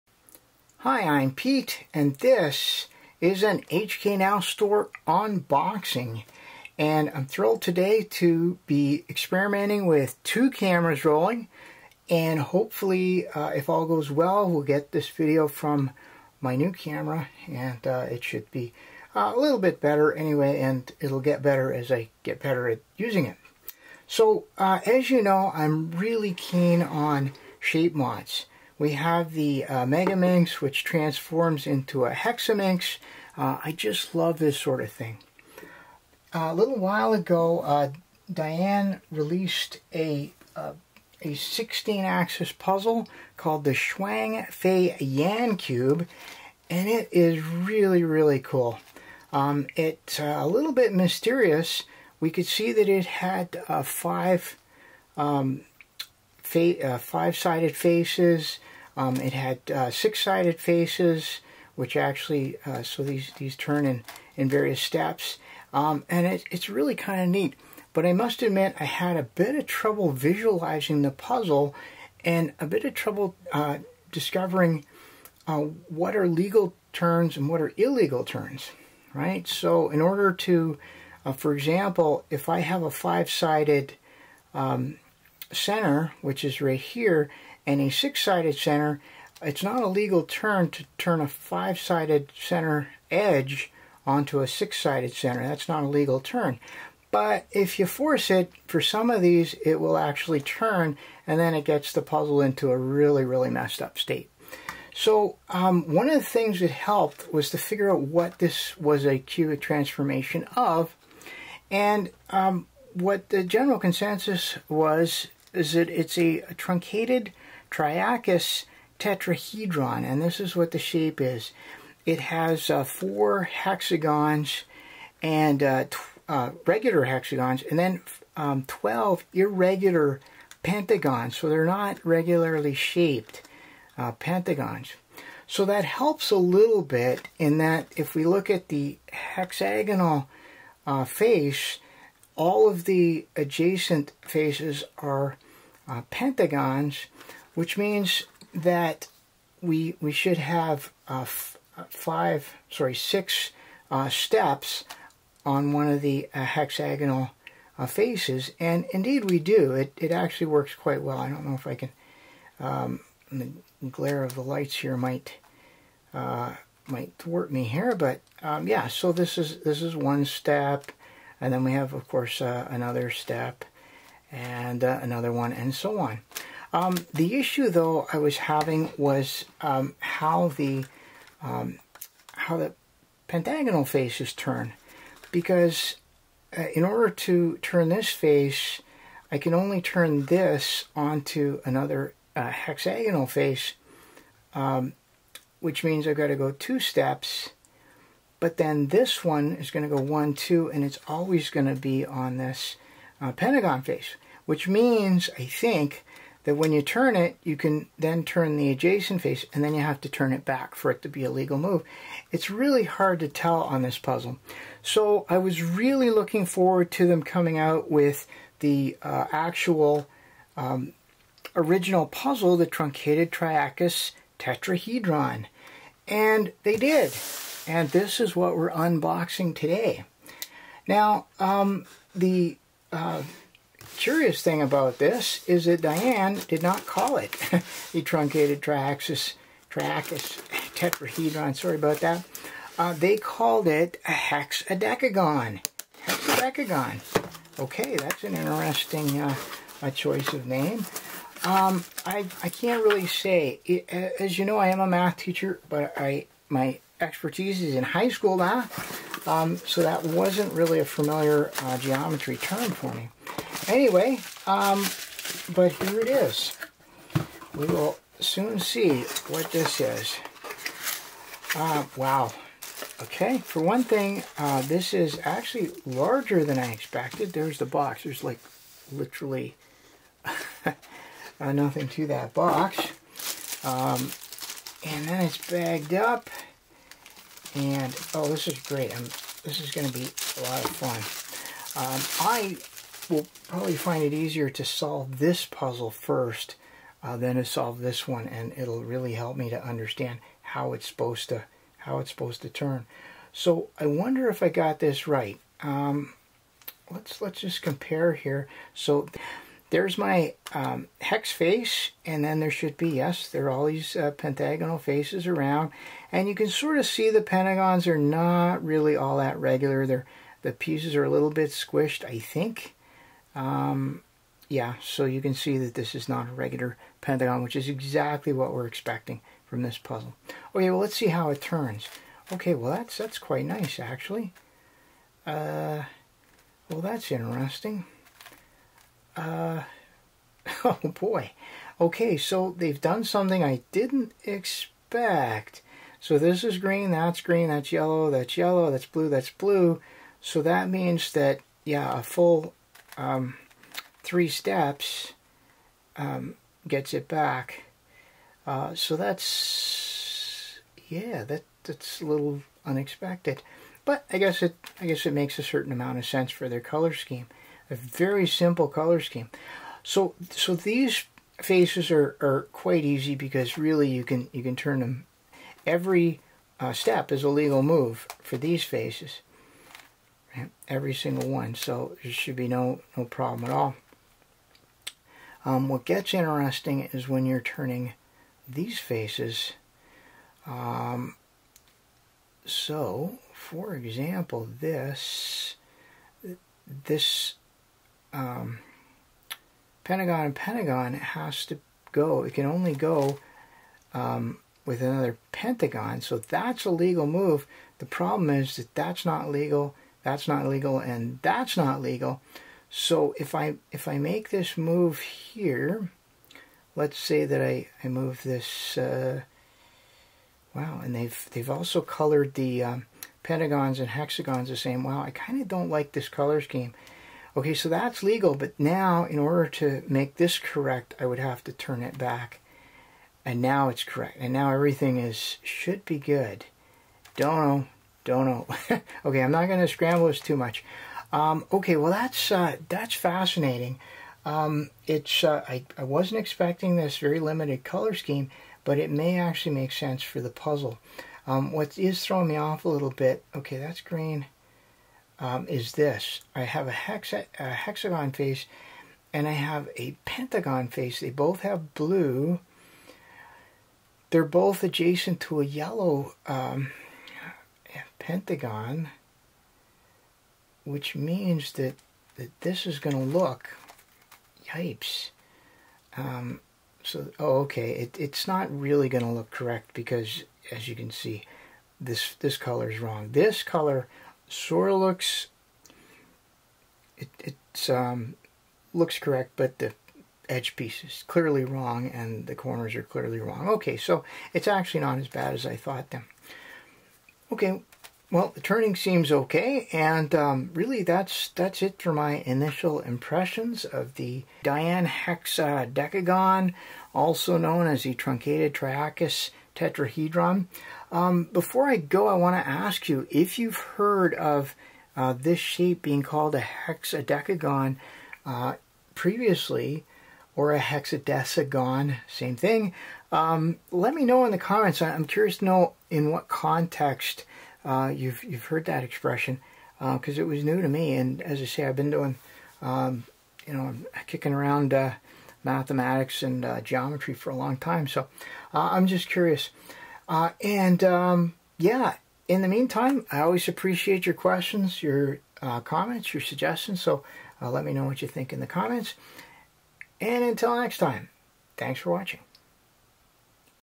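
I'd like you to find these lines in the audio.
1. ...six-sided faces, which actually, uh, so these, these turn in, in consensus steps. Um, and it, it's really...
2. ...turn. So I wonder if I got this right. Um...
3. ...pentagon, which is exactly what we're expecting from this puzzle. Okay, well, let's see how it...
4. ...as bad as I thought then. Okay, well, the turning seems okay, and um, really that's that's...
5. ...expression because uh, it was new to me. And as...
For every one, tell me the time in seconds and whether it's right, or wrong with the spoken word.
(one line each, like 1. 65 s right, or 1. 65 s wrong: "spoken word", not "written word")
1. 59 s wrong: "various", not "consensus"
2. 302 s right
3. 326 s right
4. 494 s right
5. 528 s right.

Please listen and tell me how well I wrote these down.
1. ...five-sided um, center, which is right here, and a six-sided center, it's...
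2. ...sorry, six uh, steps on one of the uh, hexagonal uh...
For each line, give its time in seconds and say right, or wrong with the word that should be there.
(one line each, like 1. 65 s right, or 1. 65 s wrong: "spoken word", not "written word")
1. 82 s right
2. 152 s right.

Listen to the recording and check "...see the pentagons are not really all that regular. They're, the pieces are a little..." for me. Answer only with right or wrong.
right.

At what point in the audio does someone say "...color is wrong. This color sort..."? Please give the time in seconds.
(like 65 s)
482 s.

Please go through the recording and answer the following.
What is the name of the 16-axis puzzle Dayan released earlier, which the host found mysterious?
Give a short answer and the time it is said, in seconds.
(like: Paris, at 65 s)
Shuang Fei Yan Cube, at 43 s.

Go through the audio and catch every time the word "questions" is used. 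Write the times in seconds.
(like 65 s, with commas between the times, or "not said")
544 s.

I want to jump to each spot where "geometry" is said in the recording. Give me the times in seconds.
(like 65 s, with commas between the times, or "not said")
261 s, 536 s.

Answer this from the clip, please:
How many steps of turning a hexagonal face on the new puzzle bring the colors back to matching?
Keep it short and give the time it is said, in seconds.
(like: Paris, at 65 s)
3, at 354 s.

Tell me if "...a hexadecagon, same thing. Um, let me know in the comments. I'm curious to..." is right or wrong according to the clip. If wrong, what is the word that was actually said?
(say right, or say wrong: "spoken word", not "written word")
right.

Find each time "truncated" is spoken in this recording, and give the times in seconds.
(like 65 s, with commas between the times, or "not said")
116 s, 222 s, 238 s, 507 s.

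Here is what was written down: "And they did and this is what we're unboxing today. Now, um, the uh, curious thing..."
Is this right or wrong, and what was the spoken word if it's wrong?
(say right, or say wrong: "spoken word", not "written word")
right.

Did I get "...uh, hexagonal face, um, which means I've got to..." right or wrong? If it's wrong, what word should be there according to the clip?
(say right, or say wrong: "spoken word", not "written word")
right.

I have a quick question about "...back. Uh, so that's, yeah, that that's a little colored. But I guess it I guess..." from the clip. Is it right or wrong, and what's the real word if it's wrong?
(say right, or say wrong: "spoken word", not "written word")
wrong: "unexpected", not "colored".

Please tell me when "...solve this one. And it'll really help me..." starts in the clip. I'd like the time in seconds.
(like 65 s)
297 s.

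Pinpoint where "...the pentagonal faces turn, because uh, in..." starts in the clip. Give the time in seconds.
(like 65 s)
182 s.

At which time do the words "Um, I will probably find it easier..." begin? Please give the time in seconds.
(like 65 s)
291 s.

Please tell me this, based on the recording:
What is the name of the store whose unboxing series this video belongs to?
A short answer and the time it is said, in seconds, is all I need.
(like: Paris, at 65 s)
HK Now Store, at 3 s.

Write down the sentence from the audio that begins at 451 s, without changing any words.
Um, what is throwing me off a little bit, okay, that's green um, is this.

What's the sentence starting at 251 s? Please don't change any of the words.
Um, I, I can't really say.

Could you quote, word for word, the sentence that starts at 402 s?
It can only go um, with another Pentagon.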